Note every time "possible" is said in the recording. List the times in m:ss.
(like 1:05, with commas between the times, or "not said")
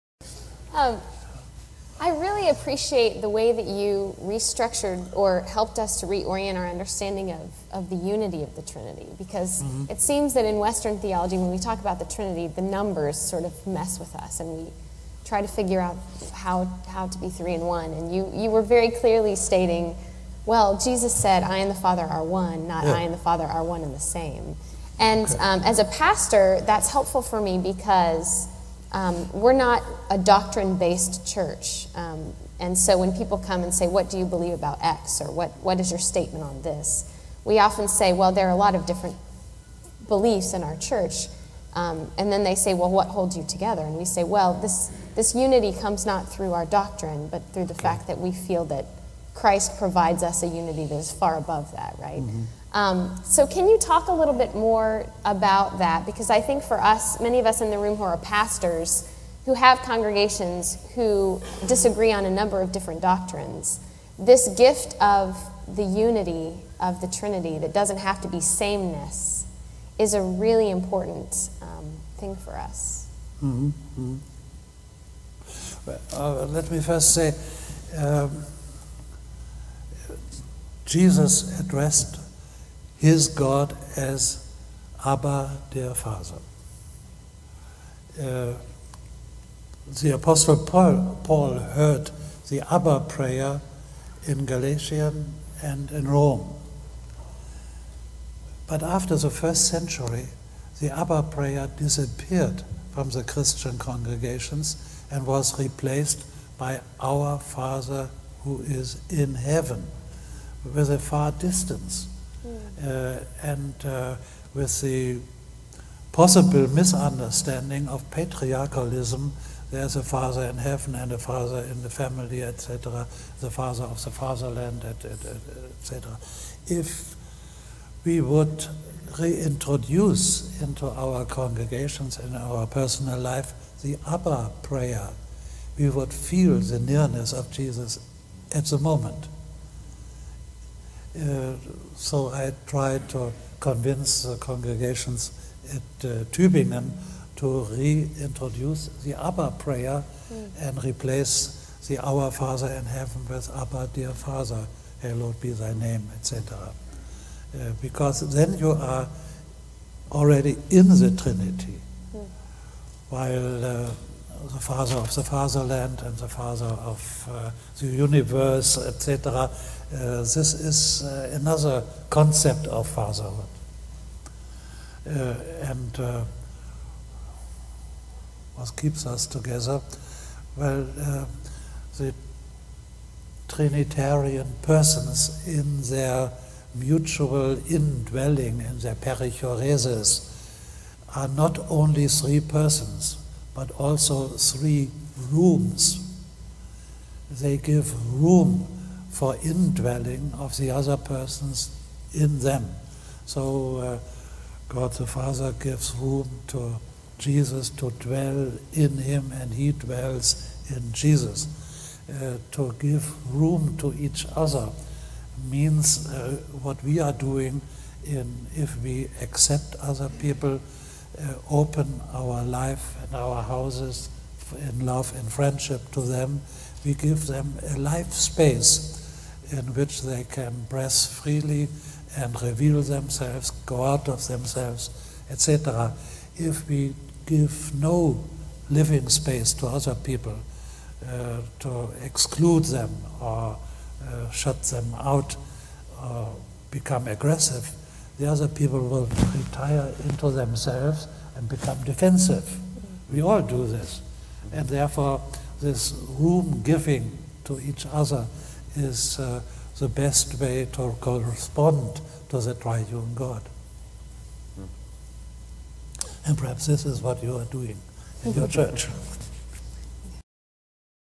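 1:56.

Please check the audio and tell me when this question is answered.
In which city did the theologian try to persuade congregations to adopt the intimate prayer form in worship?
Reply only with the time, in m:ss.
2:26.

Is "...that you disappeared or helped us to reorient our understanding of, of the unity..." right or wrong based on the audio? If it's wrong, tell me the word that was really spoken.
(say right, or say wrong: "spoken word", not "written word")
wrong: "restructured", not "disappeared".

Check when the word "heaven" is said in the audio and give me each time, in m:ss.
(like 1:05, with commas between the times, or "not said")
1:49, 2:00, 2:32.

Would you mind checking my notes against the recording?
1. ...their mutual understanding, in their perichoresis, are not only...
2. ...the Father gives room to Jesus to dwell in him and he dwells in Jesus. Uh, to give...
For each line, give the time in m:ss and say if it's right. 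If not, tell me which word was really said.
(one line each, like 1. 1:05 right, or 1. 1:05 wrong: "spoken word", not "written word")
1. 3:05 wrong: "indwelling", not "understanding"
2. 3:24 right.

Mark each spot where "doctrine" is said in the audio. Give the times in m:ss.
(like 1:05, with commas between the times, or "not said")
0:30, 0:46, 1:03.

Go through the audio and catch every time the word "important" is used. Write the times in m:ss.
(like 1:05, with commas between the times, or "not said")
1:10.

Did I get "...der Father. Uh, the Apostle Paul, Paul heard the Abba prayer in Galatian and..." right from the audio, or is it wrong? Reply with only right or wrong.
right.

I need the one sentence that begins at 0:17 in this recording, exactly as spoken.
And you, you were very clearly stating, well, Jesus said, I and the Father are one, not yeah.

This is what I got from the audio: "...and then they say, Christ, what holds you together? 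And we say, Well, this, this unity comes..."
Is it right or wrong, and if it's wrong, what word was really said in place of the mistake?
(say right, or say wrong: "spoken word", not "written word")
wrong: "Well", not "Christ".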